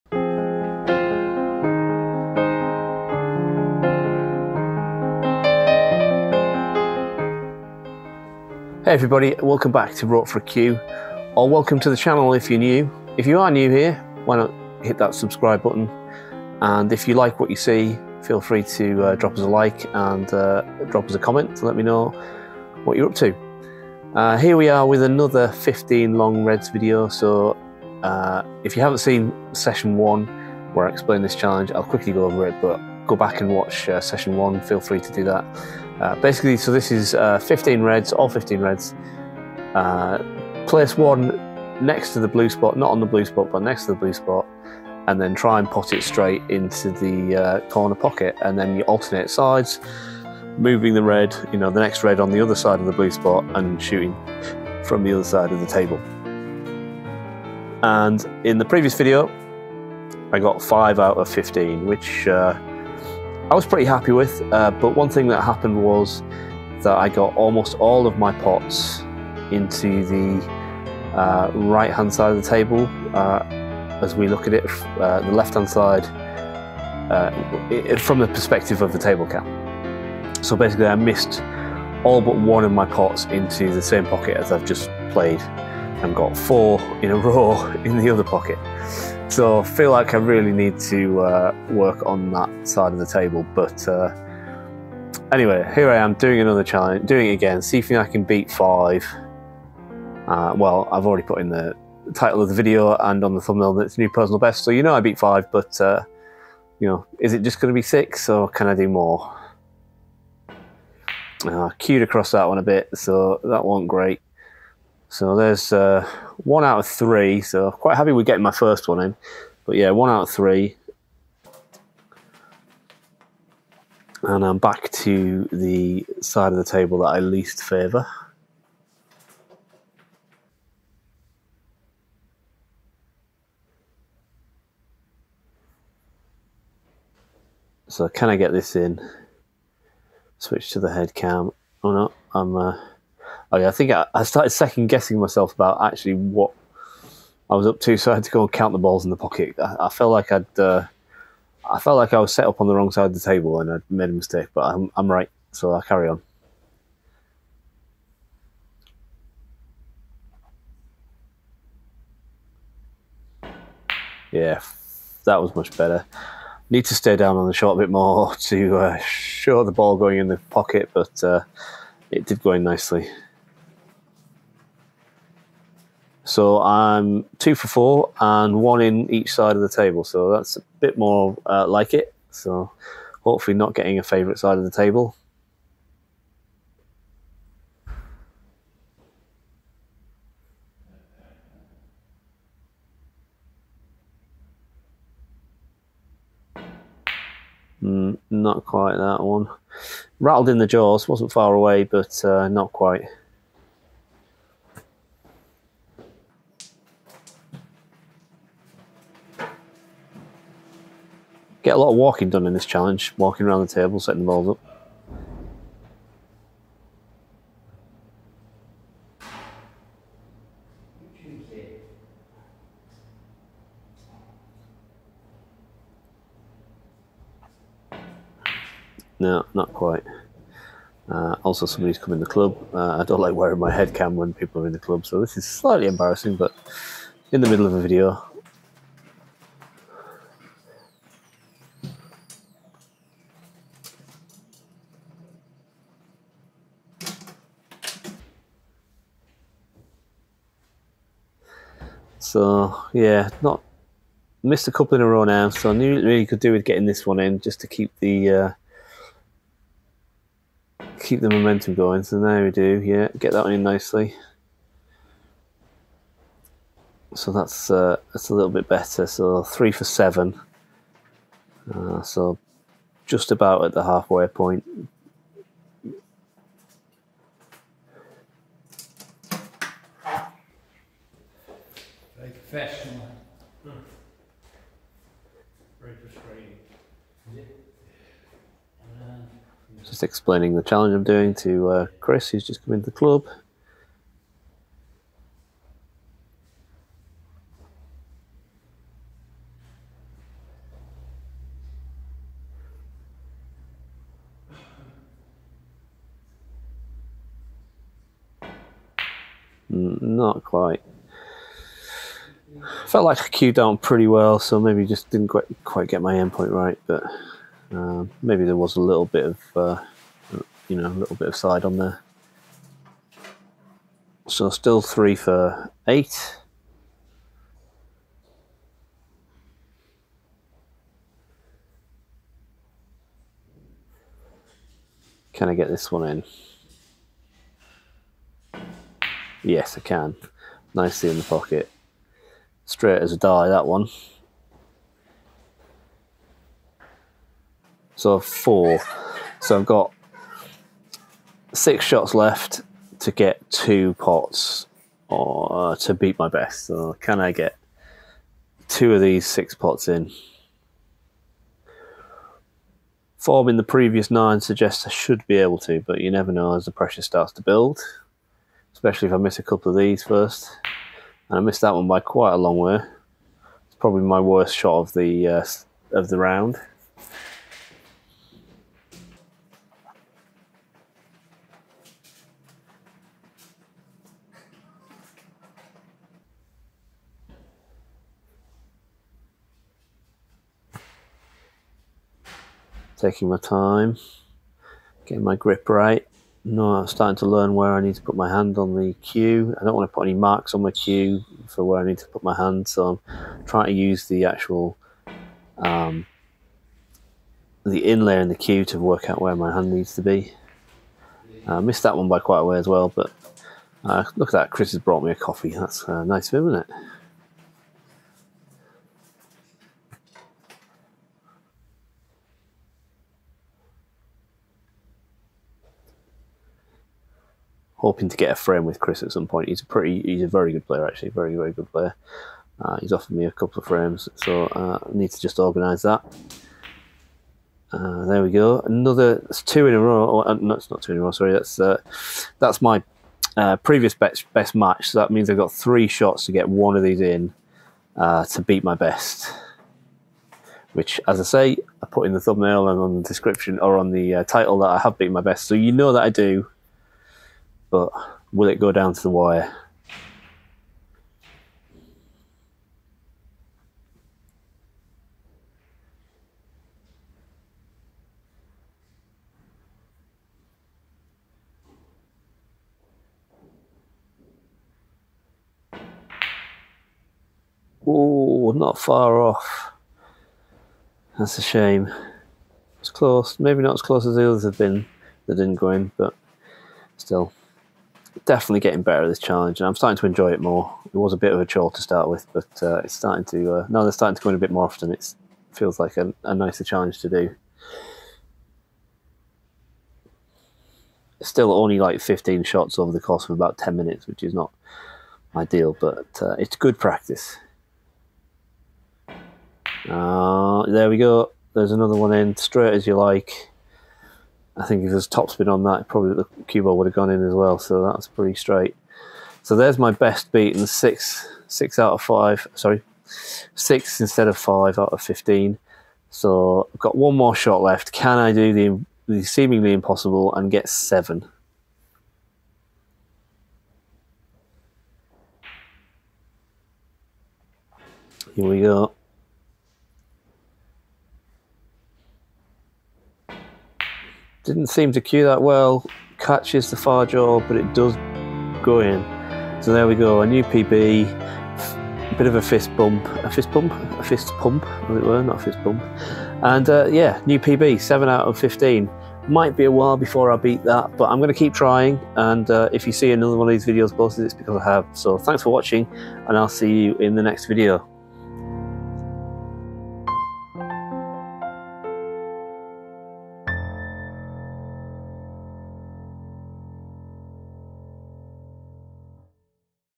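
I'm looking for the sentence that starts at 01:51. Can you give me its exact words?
Uh, cued across that one a bit, so that wasn't great.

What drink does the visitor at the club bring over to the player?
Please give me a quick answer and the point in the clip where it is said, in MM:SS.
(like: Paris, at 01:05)
coffee, at 06:55.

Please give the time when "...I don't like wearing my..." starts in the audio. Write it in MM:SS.
03:52.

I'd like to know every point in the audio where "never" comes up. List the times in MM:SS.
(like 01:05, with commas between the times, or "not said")
06:06.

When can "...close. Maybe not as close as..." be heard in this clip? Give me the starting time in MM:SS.
08:02.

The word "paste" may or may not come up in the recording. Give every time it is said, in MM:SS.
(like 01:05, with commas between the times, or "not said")
not said.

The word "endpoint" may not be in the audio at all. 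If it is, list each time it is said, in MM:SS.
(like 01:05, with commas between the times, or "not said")
05:16.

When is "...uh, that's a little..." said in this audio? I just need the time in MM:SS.
04:27.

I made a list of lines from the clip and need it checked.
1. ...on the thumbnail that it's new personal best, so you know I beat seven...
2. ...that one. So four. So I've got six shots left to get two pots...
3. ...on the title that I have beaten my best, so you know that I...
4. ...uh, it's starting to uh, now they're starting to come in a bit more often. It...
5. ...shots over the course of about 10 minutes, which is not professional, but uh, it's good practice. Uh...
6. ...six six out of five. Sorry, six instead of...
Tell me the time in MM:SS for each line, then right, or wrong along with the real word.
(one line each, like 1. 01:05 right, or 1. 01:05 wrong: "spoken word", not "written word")
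1. 01:43 wrong: "five", not "seven"
2. 05:43 right
3. 07:33 right
4. 08:12 right
5. 08:22 wrong: "ideal", not "professional"
6. 08:40 right.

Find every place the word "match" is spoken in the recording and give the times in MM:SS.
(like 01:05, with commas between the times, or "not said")
07:24.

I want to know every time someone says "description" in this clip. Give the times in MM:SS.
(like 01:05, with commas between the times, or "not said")
07:33.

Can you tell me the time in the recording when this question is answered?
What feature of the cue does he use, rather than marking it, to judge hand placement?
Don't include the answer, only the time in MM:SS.
06:47.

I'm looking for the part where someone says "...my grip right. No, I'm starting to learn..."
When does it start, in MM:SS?
06:35.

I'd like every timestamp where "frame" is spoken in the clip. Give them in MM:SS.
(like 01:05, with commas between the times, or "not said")
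07:08, 07:13.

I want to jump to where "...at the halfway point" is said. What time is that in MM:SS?
04:33.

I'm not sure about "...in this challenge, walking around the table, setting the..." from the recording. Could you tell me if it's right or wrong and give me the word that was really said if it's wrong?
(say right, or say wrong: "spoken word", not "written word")
right.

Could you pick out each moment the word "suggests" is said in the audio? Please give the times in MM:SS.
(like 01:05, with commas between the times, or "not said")
06:04.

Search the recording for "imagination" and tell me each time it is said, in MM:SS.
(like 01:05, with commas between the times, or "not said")
not said.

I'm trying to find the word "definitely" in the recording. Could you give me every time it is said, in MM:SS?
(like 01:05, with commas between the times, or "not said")
08:08.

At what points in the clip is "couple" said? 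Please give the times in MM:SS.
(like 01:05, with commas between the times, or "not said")
04:14, 06:09, 07:13.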